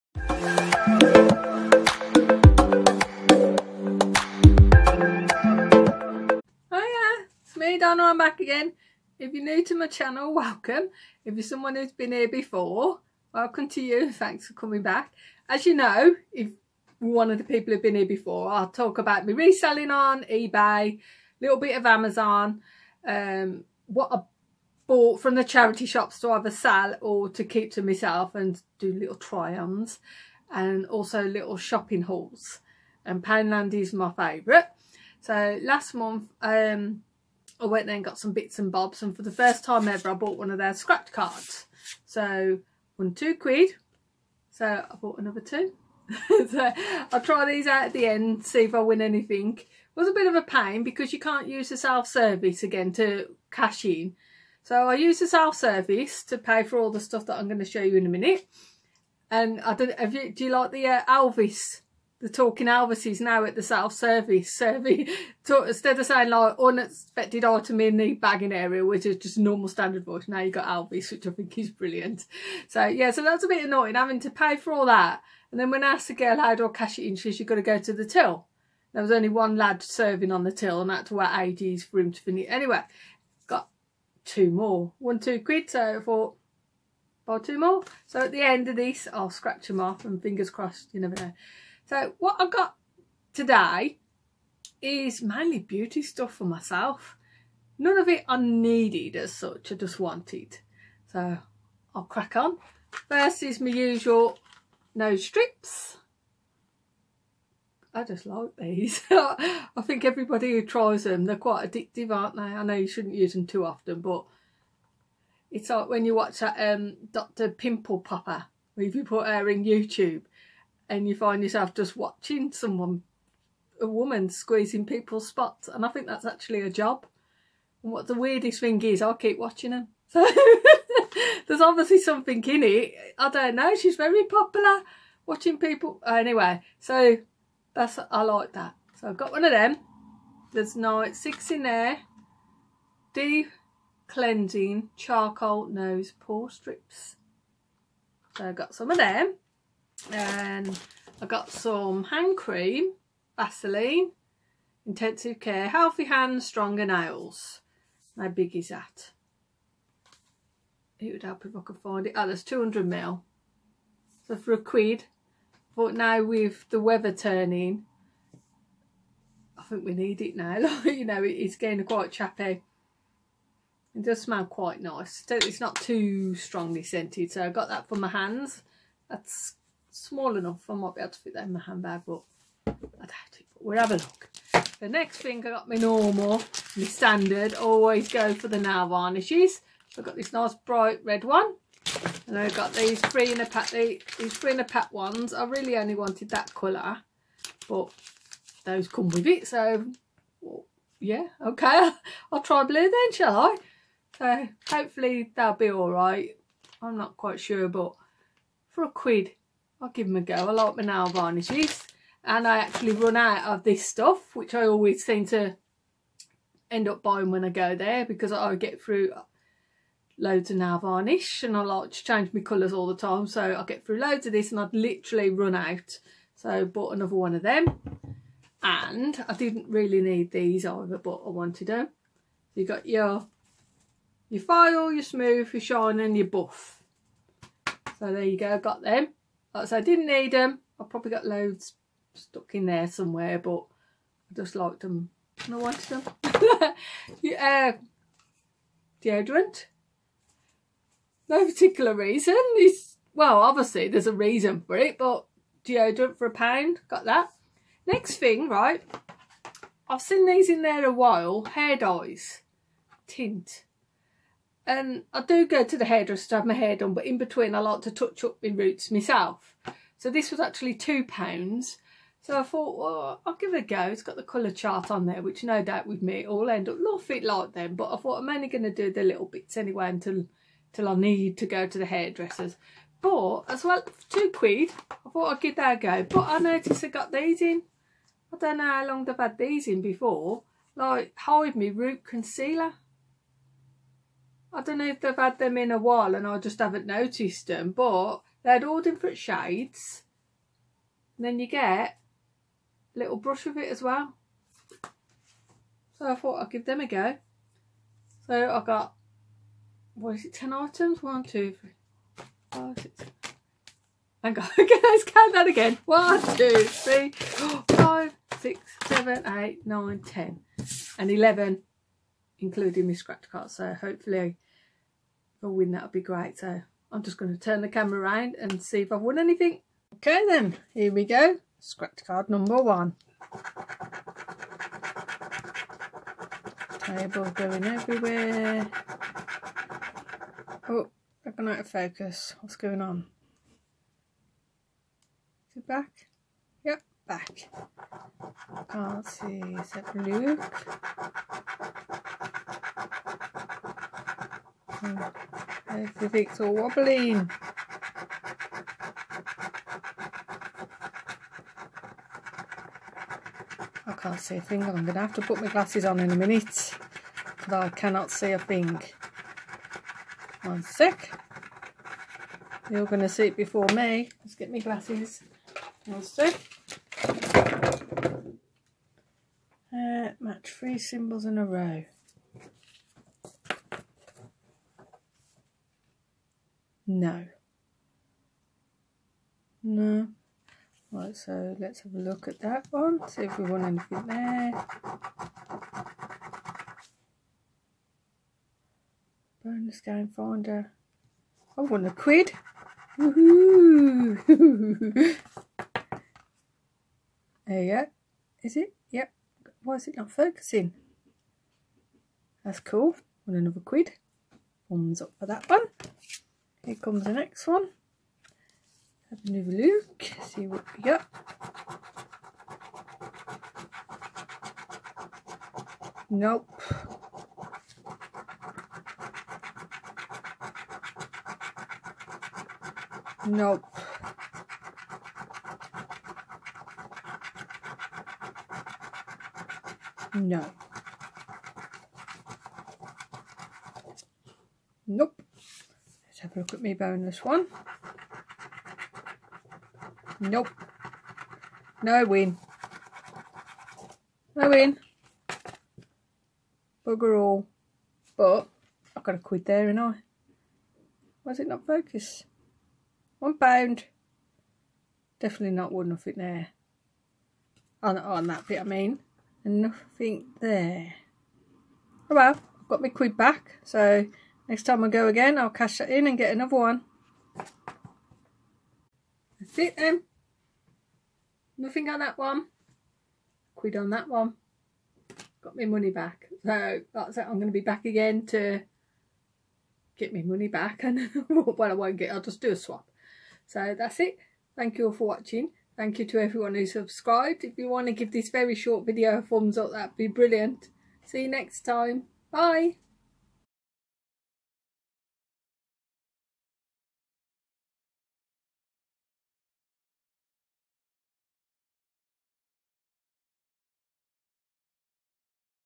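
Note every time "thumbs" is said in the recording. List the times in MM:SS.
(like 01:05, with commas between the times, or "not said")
06:54, 08:19.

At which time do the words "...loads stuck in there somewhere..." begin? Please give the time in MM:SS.
04:01.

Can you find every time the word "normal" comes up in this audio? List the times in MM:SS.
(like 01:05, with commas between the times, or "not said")
01:09, 03:05.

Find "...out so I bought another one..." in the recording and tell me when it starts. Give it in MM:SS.
03:45.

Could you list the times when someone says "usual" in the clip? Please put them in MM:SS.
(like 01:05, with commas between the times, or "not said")
01:43.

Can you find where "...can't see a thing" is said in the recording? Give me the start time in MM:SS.
06:03.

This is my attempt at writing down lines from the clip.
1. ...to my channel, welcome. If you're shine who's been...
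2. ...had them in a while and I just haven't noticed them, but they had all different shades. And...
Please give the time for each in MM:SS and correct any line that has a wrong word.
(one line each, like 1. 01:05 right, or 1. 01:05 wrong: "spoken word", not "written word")
1. 00:09 wrong: "someone", not "shine"
2. 04:55 right.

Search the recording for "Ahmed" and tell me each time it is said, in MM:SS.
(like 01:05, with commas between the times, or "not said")
not said.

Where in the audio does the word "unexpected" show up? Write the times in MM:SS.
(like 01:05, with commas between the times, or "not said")
01:06.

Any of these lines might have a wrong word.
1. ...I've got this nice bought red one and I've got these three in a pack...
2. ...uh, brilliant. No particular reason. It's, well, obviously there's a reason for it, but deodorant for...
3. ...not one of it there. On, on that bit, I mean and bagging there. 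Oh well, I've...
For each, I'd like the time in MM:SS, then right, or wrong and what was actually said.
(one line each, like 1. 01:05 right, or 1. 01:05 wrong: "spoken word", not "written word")
1. 03:09 wrong: "bright", not "bought"
2. 04:07 wrong: "deodorant", not "brilliant"
3. 07:45 wrong: "nothing", not "bagging".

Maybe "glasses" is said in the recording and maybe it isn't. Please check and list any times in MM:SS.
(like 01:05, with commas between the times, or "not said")
06:05, 06:14.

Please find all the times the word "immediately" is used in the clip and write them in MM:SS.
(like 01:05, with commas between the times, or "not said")
not said.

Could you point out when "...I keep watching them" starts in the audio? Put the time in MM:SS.
02:09.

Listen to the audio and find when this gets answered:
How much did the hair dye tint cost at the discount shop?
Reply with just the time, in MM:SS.
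04:30.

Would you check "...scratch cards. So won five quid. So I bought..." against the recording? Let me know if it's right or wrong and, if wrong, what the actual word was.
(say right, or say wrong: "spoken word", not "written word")
wrong: "two", not "five".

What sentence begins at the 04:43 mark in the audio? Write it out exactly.
But as well, two quid, I thought I'd give that a go.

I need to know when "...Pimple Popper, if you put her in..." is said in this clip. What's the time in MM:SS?
01:57.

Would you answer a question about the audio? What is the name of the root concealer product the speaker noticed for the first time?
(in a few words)
Hide Me Root Concealer.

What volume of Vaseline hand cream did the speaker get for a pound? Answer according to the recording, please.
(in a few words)
200 ml.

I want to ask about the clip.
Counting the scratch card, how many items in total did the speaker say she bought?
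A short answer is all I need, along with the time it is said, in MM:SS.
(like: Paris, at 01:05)
11, at 05:21.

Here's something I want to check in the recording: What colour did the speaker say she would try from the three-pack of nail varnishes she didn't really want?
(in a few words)
Blue.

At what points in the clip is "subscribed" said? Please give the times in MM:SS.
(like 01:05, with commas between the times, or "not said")
08:16.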